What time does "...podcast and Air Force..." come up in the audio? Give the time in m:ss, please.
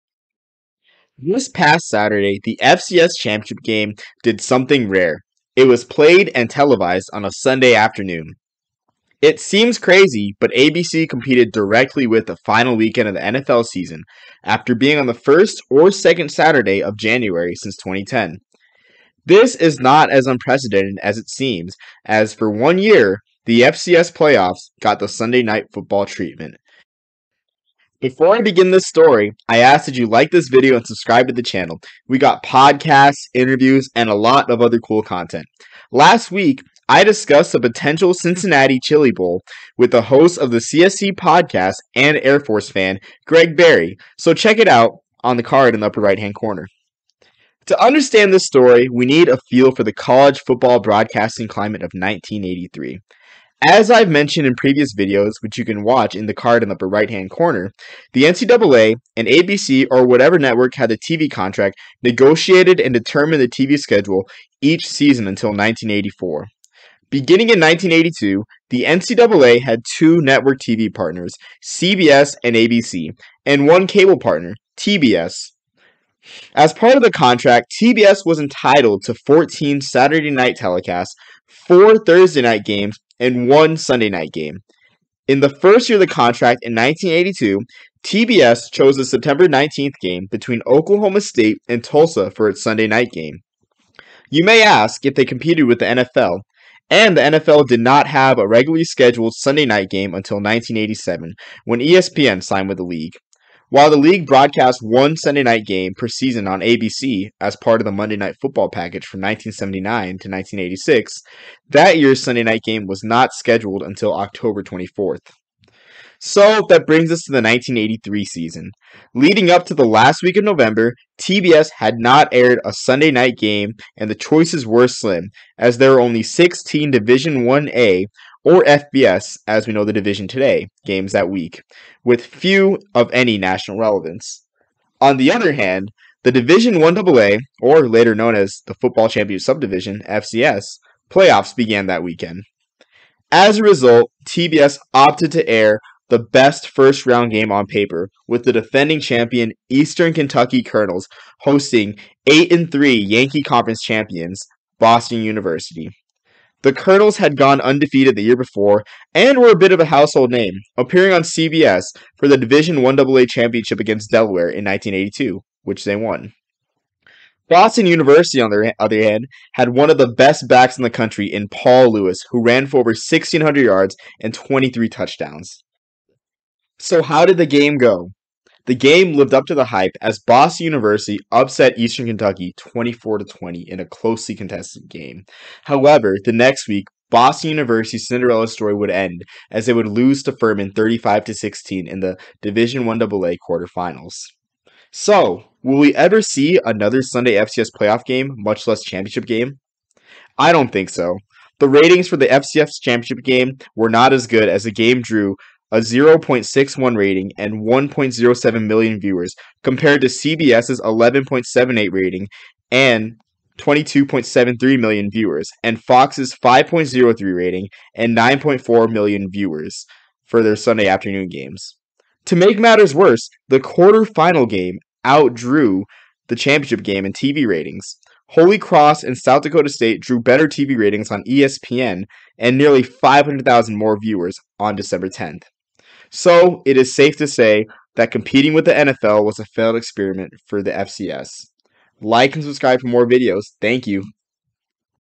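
0:41.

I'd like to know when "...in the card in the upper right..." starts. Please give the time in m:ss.
0:56.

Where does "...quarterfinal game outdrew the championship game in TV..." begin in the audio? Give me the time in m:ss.
3:43.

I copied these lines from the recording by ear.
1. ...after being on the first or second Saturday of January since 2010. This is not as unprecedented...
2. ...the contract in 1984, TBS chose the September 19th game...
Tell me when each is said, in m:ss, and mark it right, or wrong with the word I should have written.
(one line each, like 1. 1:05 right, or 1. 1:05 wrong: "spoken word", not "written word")
1. 0:14 right
2. 1:26 wrong: "1982", not "1984".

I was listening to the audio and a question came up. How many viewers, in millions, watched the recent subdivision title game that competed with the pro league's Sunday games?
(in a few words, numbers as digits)
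1.07 million.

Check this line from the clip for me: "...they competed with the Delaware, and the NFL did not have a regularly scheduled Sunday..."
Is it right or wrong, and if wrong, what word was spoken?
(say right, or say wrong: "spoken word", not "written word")
wrong: "NFL", not "Delaware".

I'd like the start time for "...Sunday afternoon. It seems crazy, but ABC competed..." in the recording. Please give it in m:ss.
0:07.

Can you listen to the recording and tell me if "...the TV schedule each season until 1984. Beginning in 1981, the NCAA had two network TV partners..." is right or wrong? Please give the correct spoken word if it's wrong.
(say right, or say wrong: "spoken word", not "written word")
wrong: "1982", not "1981".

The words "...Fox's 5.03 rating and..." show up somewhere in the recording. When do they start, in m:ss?
3:35.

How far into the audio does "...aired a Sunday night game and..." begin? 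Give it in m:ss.
2:02.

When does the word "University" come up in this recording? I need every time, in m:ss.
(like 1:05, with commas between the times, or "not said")
2:35, 2:47, 3:00, 3:07.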